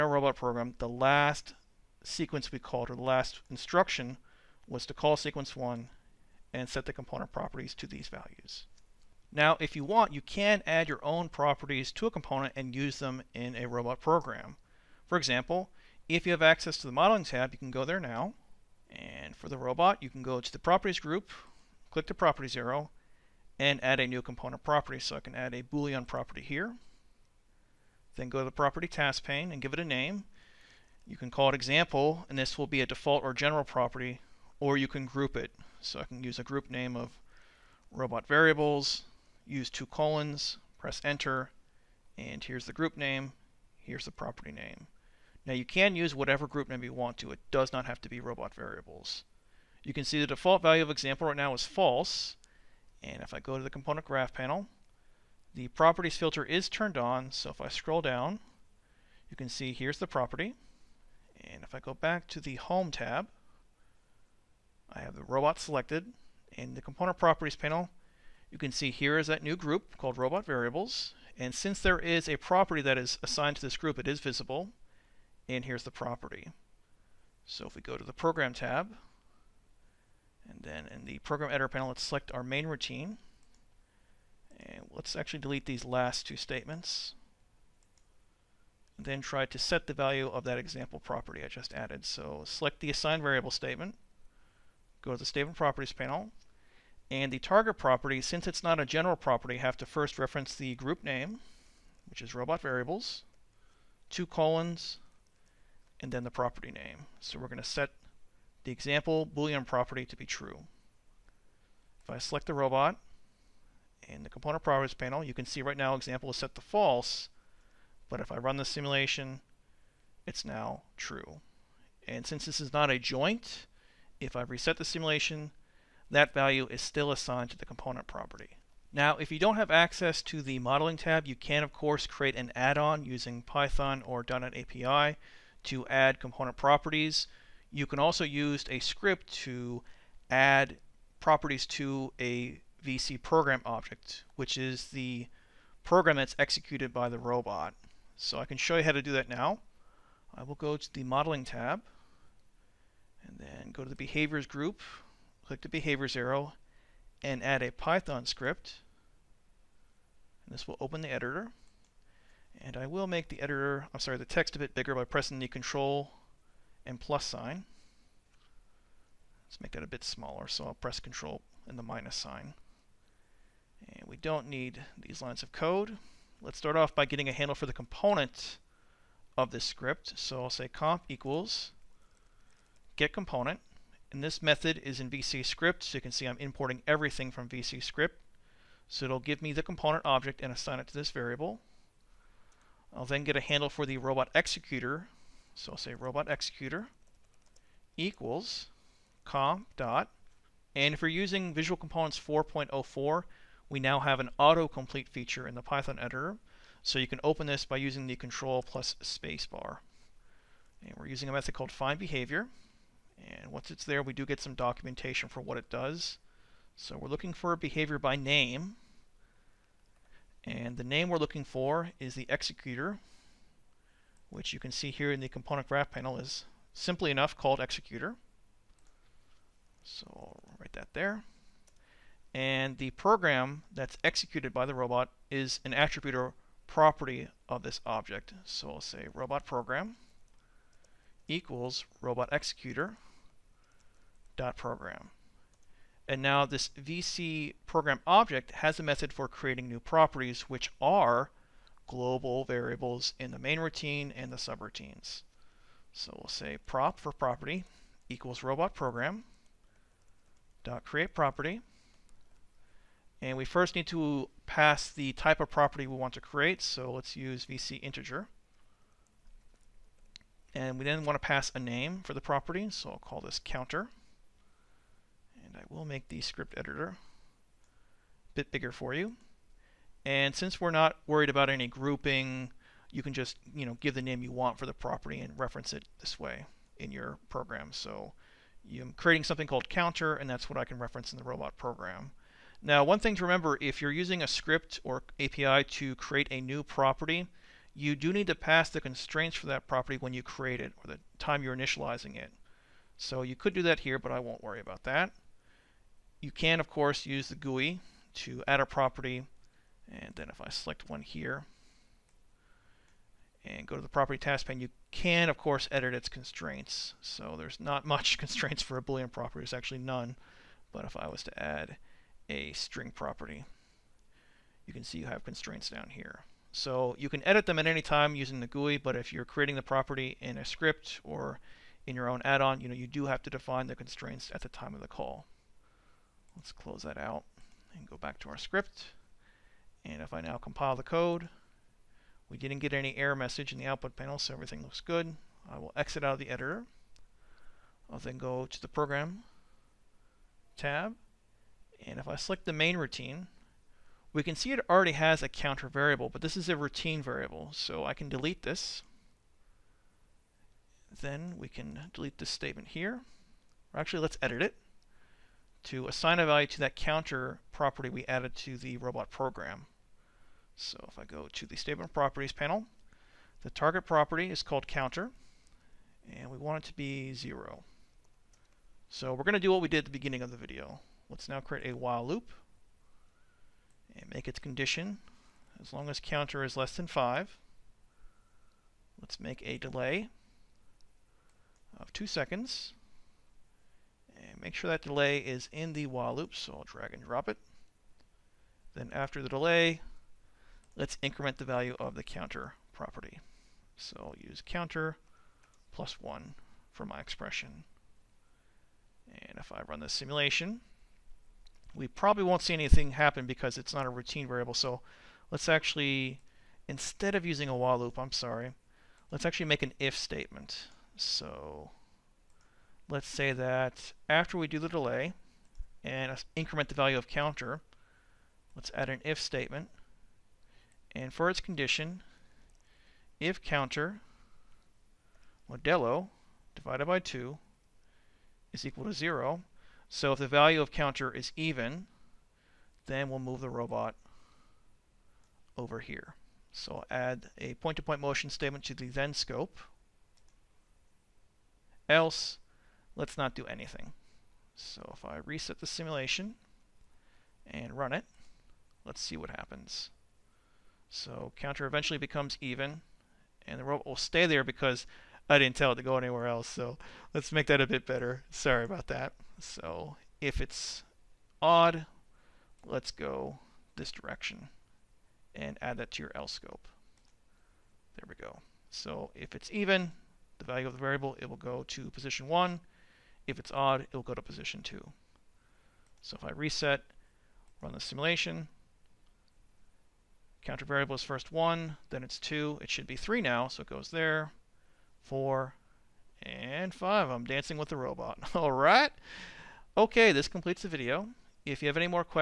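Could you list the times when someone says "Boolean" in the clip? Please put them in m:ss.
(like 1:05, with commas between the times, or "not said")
0:25, 1:49, 5:18.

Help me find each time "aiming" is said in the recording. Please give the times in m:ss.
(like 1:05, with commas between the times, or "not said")
not said.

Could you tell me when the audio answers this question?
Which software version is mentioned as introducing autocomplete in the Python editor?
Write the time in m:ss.
3:22.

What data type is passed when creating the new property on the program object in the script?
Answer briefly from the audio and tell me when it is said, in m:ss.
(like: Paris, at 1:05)
VC integer, at 4:27.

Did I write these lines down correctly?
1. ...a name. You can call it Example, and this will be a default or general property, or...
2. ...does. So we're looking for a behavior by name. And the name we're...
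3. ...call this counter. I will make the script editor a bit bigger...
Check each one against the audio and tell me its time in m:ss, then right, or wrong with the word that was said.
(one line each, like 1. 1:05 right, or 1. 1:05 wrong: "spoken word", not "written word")
1. 0:29 right
2. 3:35 right
3. 4:32 right.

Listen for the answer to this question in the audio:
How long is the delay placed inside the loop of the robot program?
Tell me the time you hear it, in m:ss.
6:31.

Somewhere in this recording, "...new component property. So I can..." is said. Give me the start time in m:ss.
0:24.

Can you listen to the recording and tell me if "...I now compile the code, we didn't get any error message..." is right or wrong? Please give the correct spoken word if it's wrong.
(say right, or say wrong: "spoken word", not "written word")
right.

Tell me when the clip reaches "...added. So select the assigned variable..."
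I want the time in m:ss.
1:31.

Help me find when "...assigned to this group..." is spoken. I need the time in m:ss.
1:13.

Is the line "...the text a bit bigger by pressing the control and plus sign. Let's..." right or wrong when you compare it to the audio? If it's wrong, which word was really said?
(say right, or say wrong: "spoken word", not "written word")
right.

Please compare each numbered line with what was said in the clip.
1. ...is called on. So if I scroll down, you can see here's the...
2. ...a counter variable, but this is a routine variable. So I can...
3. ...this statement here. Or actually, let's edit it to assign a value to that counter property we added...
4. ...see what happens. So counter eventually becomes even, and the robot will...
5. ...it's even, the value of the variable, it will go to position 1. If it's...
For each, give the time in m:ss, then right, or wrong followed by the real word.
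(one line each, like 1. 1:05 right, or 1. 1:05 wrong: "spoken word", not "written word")
1. 0:56 wrong: "turned", not "called"
2. 5:55 right
3. 6:02 right
4. 7:39 right
5. 7:59 right.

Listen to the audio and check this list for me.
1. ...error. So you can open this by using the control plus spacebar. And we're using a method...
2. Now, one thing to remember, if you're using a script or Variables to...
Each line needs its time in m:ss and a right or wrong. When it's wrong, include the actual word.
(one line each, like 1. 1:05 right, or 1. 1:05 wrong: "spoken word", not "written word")
1. 3:25 wrong: "editor", not "error"
2. 4:52 wrong: "API", not "Variables".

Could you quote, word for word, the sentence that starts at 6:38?
Then after the delay, let's increment the value of the counter property.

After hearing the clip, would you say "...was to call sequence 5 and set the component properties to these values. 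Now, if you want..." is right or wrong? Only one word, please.
wrong.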